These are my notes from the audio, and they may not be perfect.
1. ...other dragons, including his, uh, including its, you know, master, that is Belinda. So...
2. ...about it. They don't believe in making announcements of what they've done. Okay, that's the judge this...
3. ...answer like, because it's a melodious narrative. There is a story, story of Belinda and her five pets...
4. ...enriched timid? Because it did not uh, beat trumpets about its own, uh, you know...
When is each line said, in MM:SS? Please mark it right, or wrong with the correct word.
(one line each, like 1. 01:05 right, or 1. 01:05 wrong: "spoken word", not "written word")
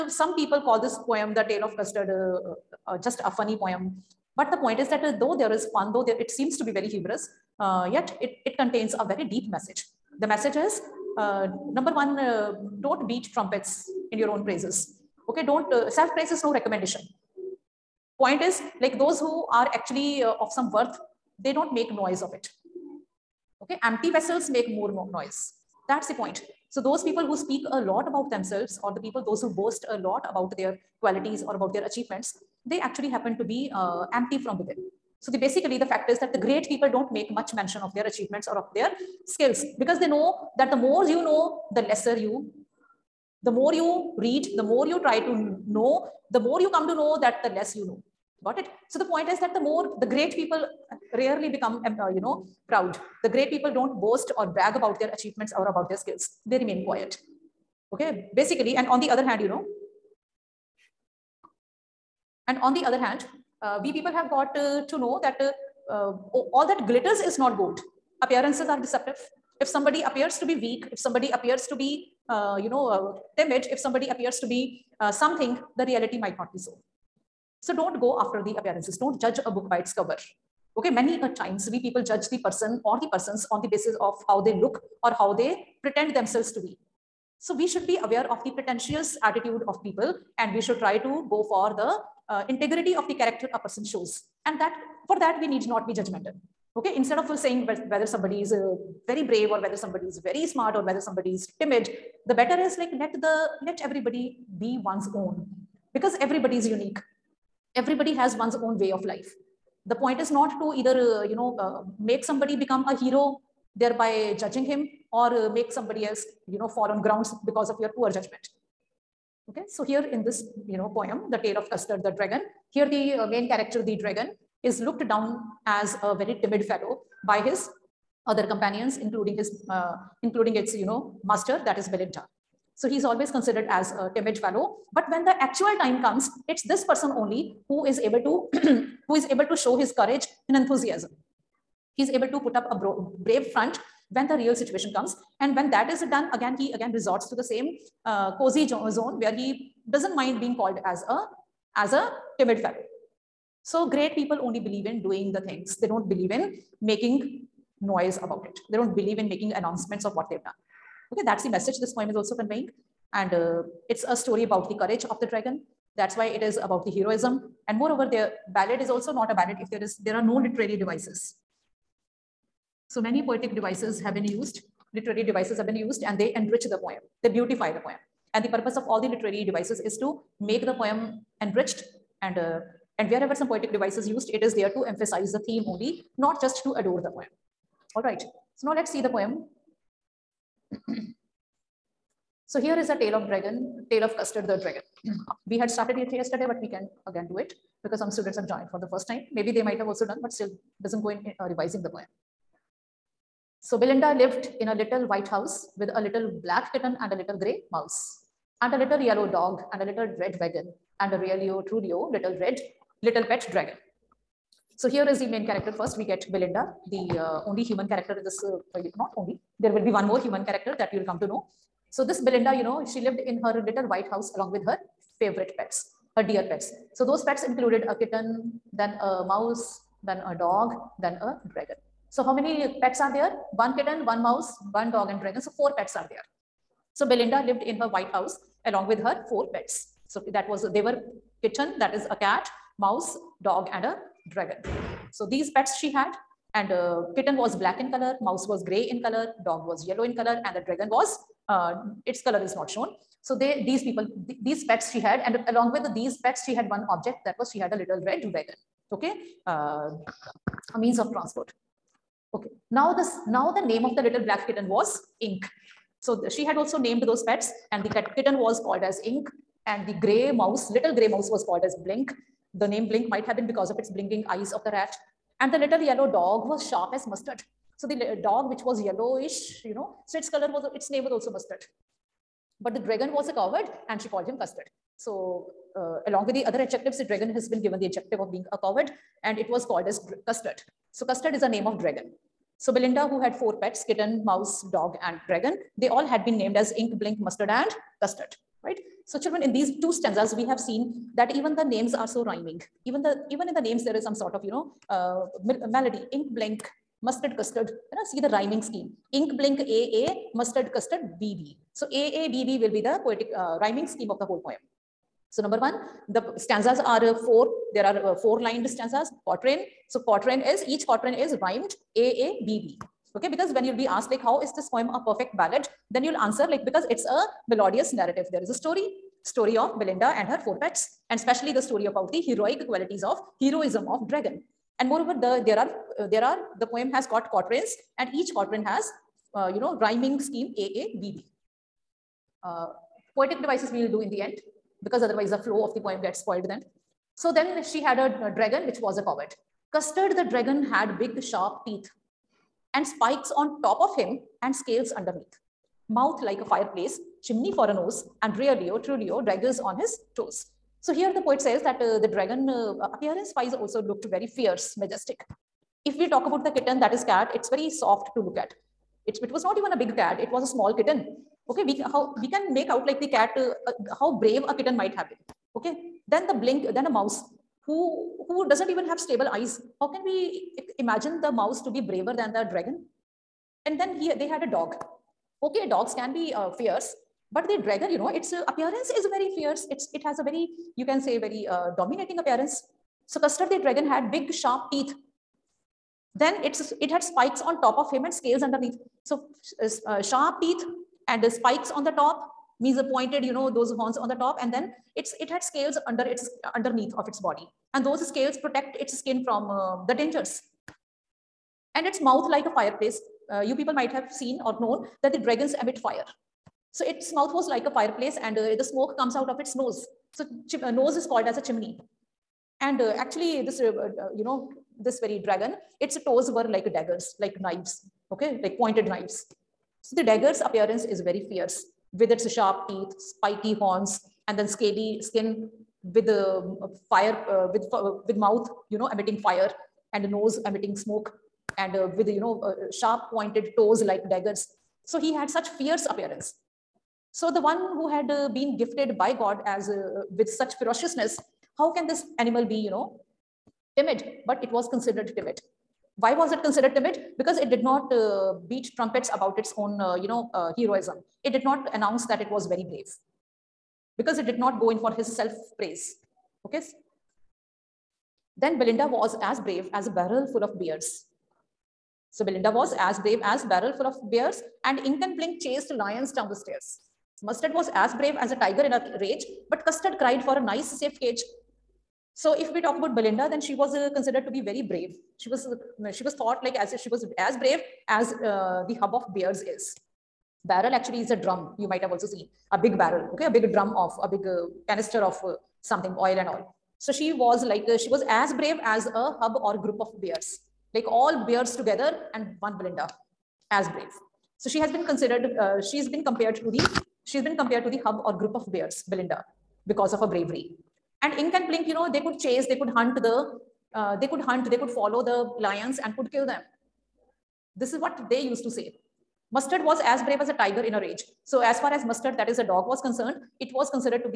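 1. 02:08 wrong: "companions", not "dragons"
2. 02:38 wrong: "message", not "judge"
3. 05:26 wrong: "four", not "five"
4. 07:36 wrong: "considered", not "enriched".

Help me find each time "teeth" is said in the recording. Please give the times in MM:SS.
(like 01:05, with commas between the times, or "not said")
05:51, 06:34, 06:40, 07:12.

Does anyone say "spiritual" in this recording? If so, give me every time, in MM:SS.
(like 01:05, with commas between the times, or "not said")
not said.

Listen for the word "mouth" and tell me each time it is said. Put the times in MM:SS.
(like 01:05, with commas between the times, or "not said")
05:55, 06:52, 06:57, 07:18.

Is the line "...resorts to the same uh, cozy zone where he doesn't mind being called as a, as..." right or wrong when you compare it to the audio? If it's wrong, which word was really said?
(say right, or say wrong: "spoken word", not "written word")
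right.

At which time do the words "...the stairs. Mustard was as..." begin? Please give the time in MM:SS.
07:56.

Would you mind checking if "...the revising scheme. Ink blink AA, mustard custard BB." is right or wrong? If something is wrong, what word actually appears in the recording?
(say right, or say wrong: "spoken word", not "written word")
wrong: "rhyming", not "revising".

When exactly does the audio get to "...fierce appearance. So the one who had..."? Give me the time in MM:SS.
07:25.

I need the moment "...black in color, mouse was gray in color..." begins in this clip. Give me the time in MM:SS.
04:07.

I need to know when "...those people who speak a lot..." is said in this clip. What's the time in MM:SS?
00:26.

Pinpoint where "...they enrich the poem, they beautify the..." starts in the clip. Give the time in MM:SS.
02:56.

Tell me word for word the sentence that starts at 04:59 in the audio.
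So children, in these two stanzas, we have seen that even the names are so rhyming.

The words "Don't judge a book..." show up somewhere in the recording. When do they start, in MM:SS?
01:18.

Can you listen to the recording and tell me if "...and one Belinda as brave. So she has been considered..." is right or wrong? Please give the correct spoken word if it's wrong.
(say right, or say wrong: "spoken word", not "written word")
right.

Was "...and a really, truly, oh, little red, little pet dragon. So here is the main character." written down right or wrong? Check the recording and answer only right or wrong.
right.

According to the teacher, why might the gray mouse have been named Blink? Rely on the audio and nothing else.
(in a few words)
Its blinking eyes.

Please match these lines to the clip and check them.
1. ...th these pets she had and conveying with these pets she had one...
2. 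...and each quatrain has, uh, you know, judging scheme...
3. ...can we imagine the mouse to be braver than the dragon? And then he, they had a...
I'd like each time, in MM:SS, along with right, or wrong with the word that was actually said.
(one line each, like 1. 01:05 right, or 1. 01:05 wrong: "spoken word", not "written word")
1. 04:14 wrong: "along", not "conveying"
2. 05:37 wrong: "rhyming", not "judging"
3. 06:19 right.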